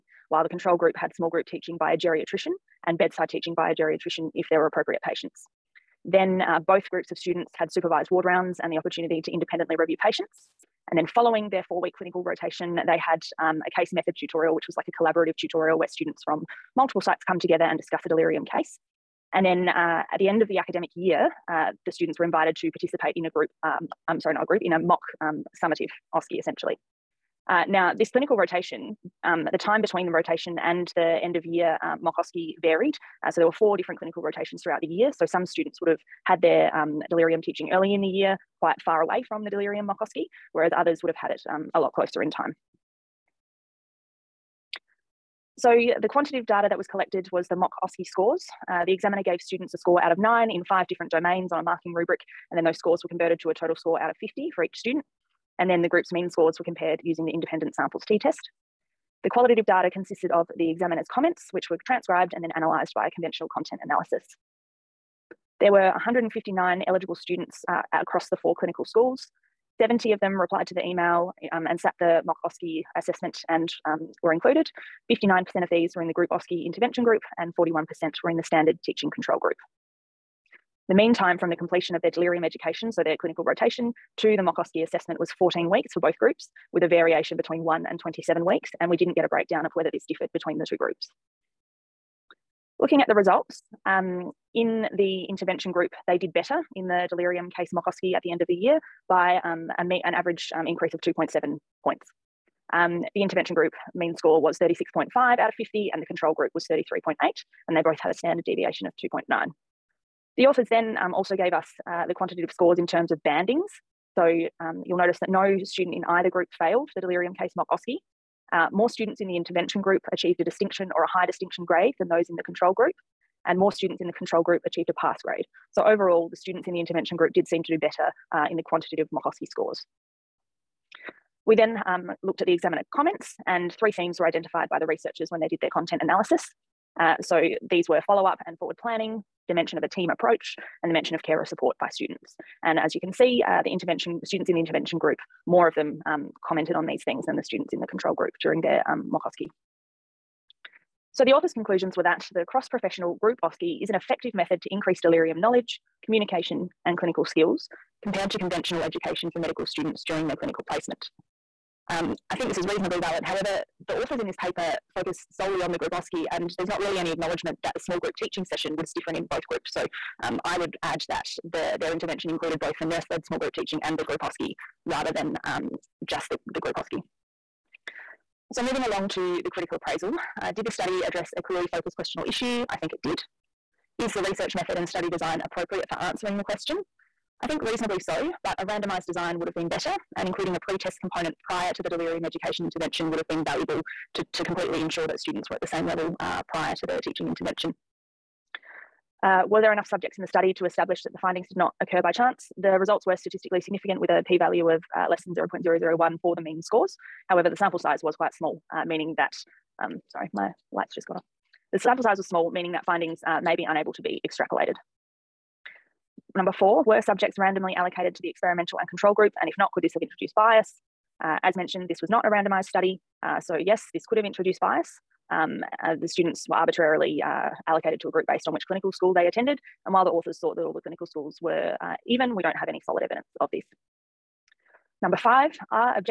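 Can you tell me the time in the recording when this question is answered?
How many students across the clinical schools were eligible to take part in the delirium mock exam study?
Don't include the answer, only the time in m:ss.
1:05.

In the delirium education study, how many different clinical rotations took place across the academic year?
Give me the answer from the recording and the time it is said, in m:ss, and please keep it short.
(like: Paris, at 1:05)
4, at 0:33.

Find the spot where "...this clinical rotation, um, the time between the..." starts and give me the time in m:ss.
0:27.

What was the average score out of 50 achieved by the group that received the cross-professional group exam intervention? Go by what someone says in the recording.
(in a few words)
36.5.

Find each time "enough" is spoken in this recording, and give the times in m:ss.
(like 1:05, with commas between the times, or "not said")
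3:19.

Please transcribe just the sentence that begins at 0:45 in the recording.
so the quantitative data that was collected was the mock OSCE scores.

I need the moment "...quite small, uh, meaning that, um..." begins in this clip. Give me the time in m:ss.
3:28.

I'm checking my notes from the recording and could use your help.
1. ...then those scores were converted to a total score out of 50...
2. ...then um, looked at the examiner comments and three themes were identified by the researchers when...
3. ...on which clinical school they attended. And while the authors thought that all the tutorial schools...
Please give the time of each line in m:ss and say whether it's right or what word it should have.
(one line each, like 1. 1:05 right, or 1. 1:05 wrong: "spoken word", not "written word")
1. 0:52 right
2. 2:11 right
3. 3:48 wrong: "clinical", not "tutorial".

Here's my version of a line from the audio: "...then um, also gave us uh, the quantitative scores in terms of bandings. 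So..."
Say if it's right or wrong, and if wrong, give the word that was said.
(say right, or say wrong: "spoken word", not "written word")
right.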